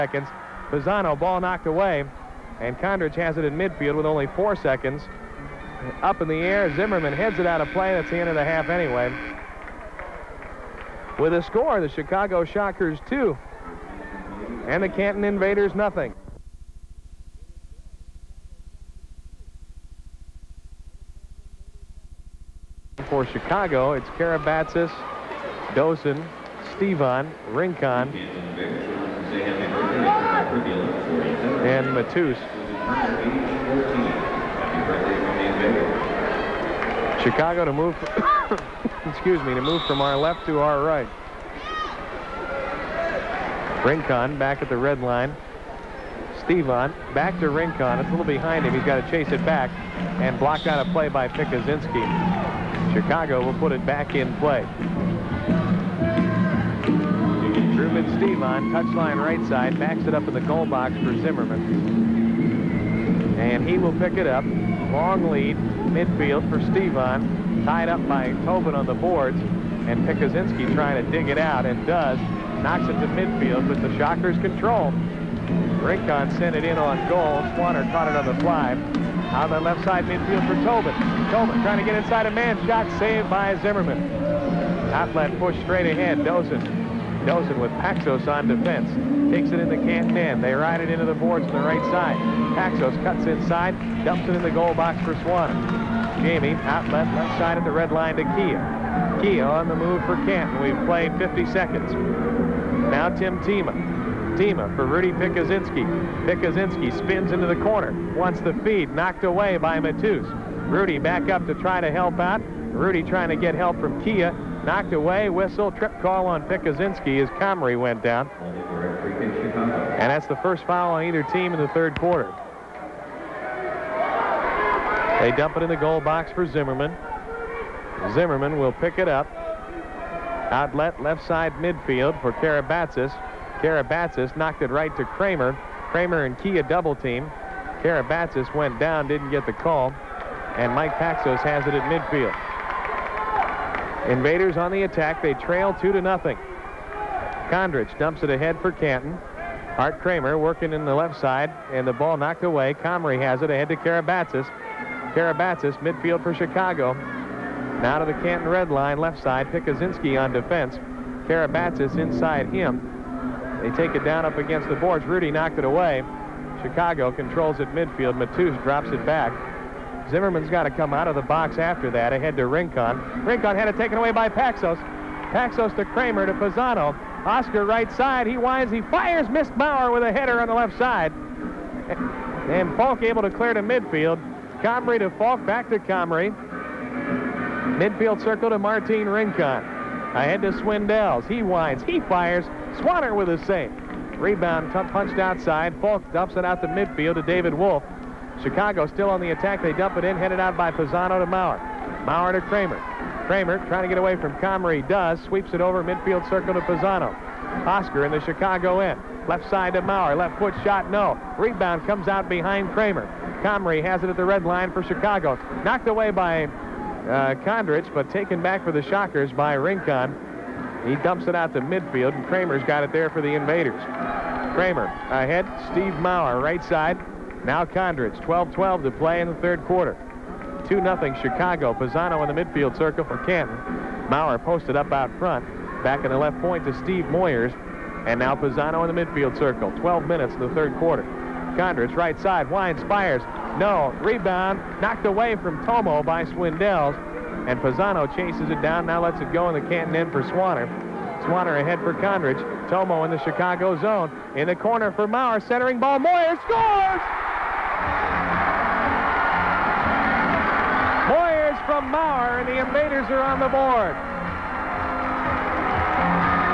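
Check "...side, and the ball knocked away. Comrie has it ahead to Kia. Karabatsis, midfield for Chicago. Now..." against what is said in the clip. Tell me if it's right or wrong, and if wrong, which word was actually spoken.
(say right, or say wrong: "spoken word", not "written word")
wrong: "Karabatsis", not "Kia".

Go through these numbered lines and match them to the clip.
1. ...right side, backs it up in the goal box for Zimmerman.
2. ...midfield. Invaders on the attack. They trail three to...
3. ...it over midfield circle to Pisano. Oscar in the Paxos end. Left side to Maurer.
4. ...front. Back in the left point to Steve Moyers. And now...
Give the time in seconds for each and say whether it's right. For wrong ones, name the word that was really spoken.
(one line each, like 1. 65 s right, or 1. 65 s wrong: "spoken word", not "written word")
1. 59 s right
2. 141 s wrong: "two", not "three"
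3. 205 s wrong: "Chicago", not "Paxos"
4. 235 s right.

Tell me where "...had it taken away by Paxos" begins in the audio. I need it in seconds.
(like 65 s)
173 s.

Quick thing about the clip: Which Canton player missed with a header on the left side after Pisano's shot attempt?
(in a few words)
Bauer.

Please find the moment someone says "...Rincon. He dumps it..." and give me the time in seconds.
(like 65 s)
219 s.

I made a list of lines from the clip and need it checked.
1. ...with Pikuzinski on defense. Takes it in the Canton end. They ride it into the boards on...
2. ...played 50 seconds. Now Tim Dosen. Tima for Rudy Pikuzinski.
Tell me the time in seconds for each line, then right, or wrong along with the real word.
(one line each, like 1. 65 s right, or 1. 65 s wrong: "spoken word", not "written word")
1. 87 s wrong: "Paxos", not "Pikuzinski"
2. 100 s wrong: "Tima", not "Dosen".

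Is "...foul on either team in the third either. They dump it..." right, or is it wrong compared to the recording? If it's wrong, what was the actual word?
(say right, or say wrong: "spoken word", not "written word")
wrong: "quarter", not "either".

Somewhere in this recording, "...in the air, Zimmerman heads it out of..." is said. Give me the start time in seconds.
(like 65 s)
6 s.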